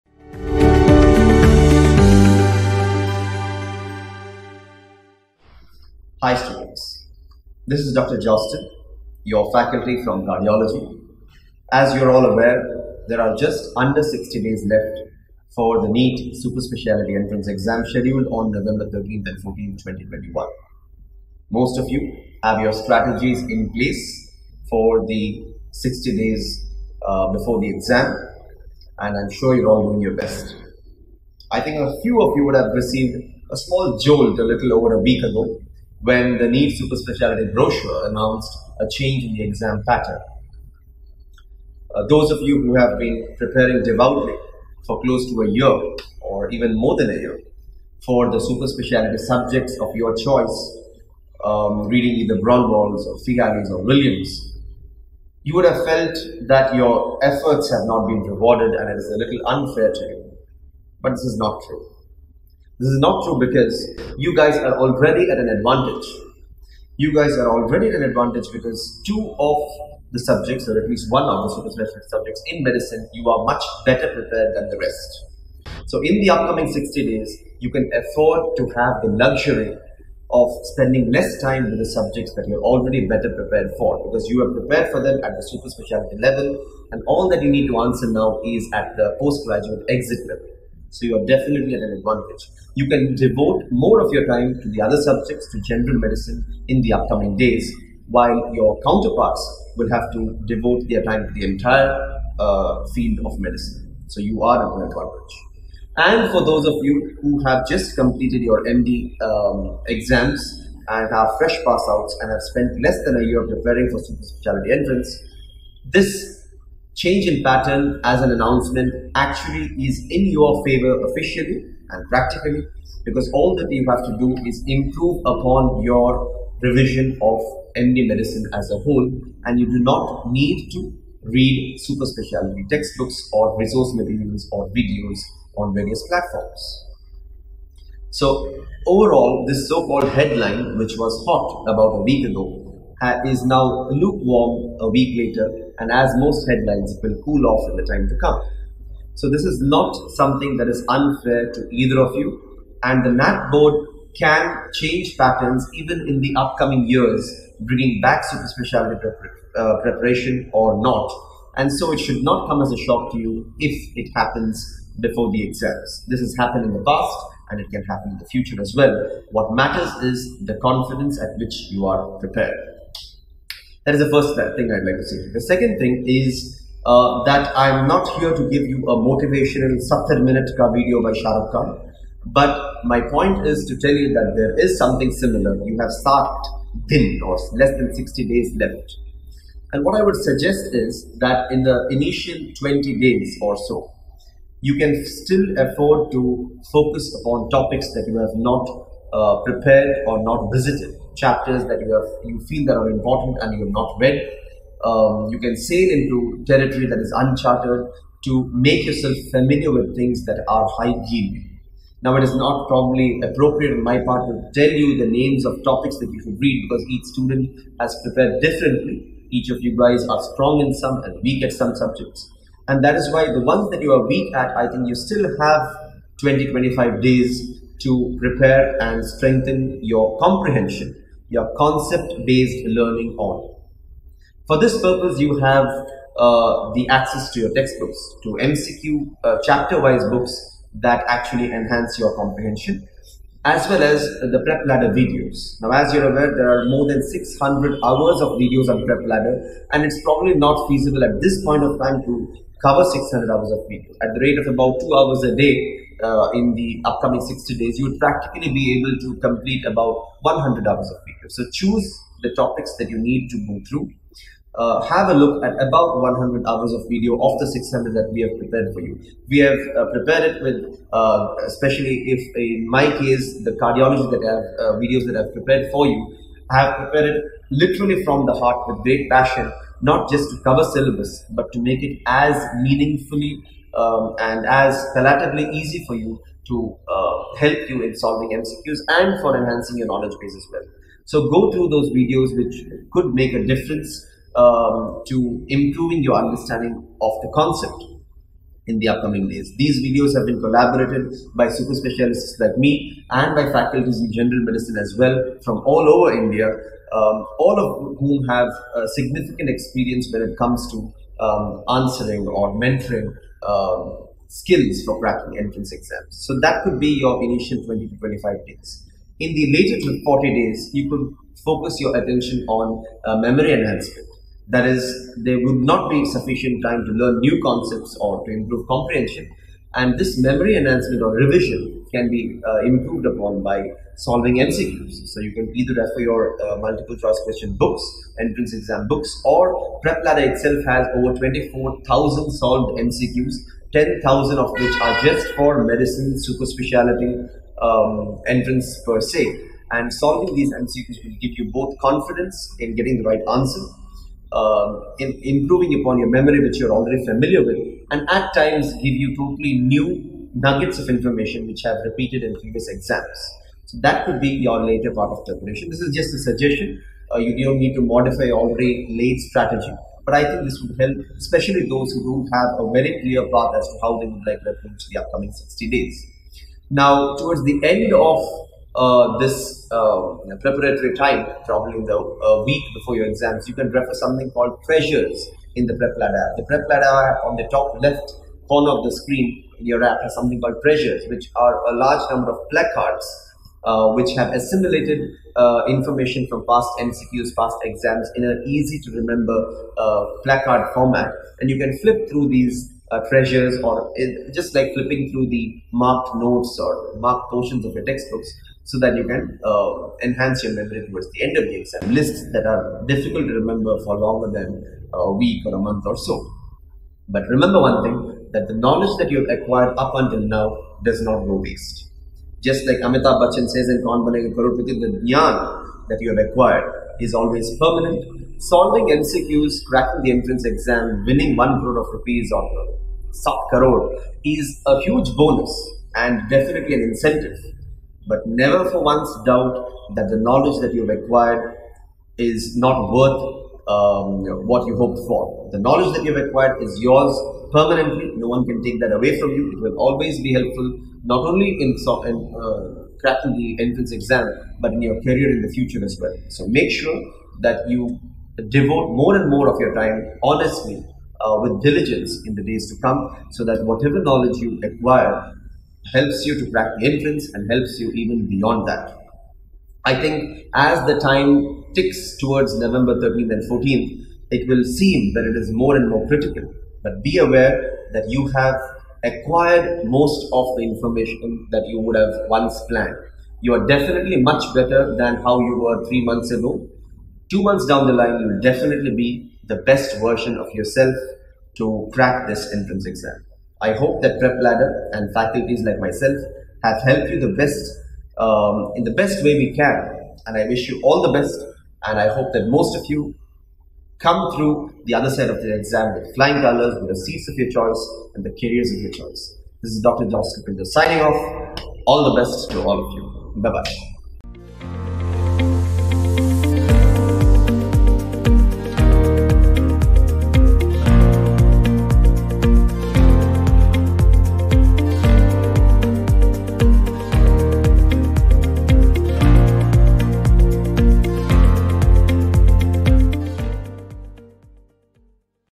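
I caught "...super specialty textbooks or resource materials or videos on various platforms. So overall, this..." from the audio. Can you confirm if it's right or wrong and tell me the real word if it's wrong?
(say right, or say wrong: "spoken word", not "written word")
right.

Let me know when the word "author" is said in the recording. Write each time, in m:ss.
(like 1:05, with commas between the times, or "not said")
not said.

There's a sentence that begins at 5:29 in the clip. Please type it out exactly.
And this memory enhancement or revision can be uh, improved upon by solving MCQs.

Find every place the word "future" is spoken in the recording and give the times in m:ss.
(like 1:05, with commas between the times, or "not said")
2:48, 7:35.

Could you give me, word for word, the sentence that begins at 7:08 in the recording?
Solving MCQs, cracking the entrance exam, winning one crore of rupees or sub crore is a huge bonus and definitely an incentive.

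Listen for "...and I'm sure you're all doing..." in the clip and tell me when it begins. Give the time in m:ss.
0:28.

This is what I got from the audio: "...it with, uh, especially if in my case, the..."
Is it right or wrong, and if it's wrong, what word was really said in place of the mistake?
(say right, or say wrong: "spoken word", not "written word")
right.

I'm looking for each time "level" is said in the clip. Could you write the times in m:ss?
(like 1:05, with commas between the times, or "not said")
1:26, 1:30.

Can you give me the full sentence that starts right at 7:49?
I think as the time ticks towards November 13th and 14th, it will seem that it is more and more critical.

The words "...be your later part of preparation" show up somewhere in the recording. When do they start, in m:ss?
6:04.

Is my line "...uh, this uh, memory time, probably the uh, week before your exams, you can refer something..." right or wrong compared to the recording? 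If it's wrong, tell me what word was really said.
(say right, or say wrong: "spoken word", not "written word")
wrong: "preparatory", not "memory".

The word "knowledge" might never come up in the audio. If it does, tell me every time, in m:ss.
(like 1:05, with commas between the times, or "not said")
4:49, 6:58, 7:20, 7:25, 7:44.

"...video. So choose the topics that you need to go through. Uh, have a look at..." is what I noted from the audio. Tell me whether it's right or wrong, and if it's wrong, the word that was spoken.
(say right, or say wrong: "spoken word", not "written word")
right.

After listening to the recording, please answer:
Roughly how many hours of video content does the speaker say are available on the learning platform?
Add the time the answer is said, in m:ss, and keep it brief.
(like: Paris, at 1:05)
600 hours, at 4:06.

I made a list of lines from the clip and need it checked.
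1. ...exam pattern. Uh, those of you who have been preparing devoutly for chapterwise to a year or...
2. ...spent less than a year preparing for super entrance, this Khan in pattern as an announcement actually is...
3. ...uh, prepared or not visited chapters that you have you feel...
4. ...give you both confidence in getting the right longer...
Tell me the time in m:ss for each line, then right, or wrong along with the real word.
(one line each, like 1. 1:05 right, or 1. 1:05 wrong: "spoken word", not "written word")
1. 0:39 wrong: "close", not "chapterwise"
2. 1:52 wrong: "Change", not "Khan"
3. 3:19 right
4. 5:51 wrong: "answer", not "longer".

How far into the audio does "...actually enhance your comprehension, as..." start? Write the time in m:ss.
4:01.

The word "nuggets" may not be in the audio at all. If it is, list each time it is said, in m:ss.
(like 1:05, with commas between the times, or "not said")
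6:00.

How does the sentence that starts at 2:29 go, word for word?
So this is not something that is unfair to either of you.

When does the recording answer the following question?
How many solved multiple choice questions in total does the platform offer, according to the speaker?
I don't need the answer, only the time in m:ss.
5:41.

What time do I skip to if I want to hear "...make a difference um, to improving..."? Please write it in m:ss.
4:53.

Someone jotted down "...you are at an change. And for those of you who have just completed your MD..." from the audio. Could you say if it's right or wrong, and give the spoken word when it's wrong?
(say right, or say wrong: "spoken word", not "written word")
wrong: "advantage", not "change".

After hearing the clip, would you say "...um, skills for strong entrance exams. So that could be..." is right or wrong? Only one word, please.
wrong.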